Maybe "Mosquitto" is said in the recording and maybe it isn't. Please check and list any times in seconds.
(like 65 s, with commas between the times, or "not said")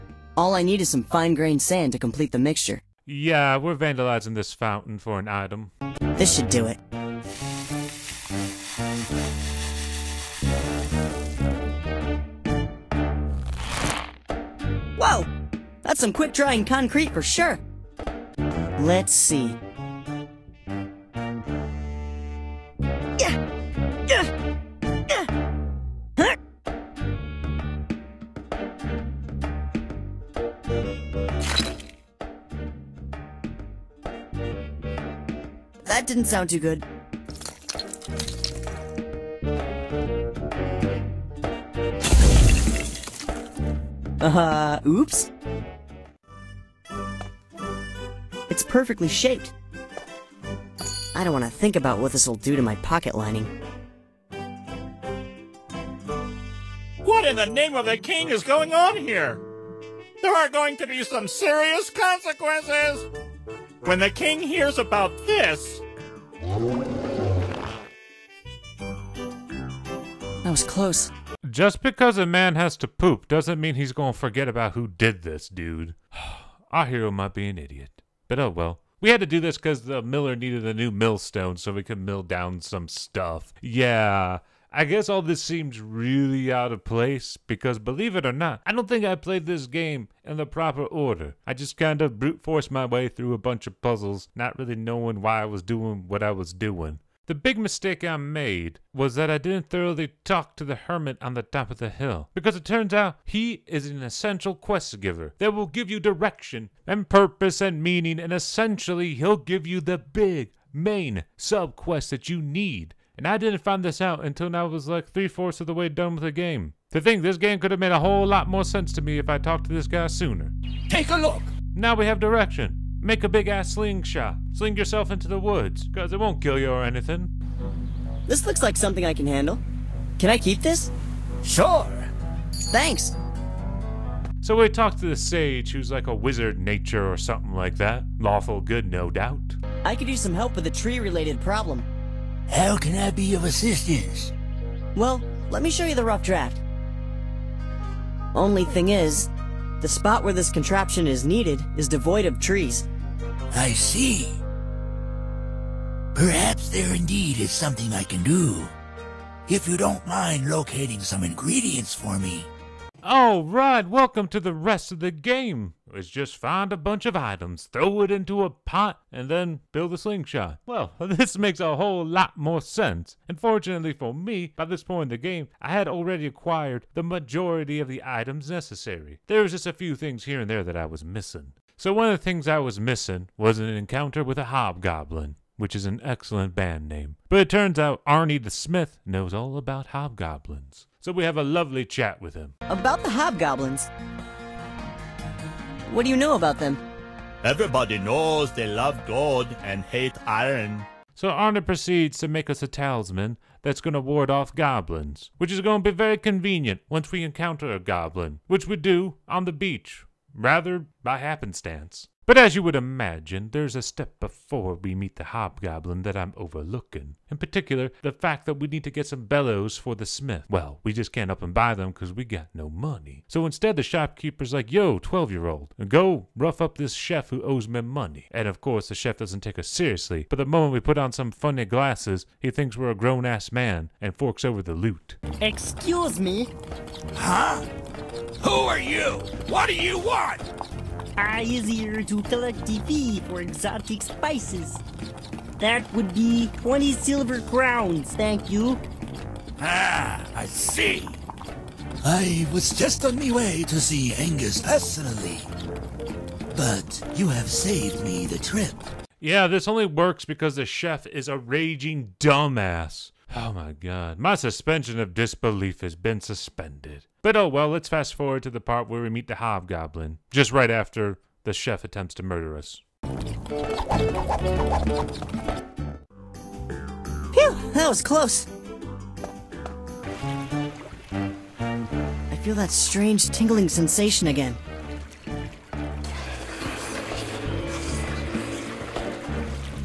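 not said.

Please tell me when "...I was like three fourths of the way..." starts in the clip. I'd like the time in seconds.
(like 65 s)
114 s.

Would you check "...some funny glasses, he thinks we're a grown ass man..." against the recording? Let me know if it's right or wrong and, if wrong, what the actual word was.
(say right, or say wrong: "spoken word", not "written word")
right.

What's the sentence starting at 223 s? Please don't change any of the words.
So instead, the shopkeeper's like, yo, 12 year old, go rough up this chef who owes me money.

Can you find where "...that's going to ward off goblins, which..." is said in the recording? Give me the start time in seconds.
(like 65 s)
203 s.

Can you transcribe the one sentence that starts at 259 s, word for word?
Yeah, this only works because the chef is a raging dumbass.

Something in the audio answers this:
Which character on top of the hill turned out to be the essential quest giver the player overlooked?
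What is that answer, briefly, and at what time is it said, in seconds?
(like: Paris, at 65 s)
The hermit, at 100 s.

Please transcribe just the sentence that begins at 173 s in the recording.
And fortunately for me, by this point in the game, I had already acquired the majority of the items necessary.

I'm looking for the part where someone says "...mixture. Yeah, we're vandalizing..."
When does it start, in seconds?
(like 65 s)
2 s.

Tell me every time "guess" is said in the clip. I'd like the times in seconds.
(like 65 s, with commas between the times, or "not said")
84 s.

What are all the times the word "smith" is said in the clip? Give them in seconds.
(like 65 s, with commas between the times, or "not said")
188 s, 220 s.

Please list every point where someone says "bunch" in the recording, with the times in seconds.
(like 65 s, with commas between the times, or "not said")
93 s, 166 s.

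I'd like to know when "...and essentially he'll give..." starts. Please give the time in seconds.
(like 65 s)
108 s.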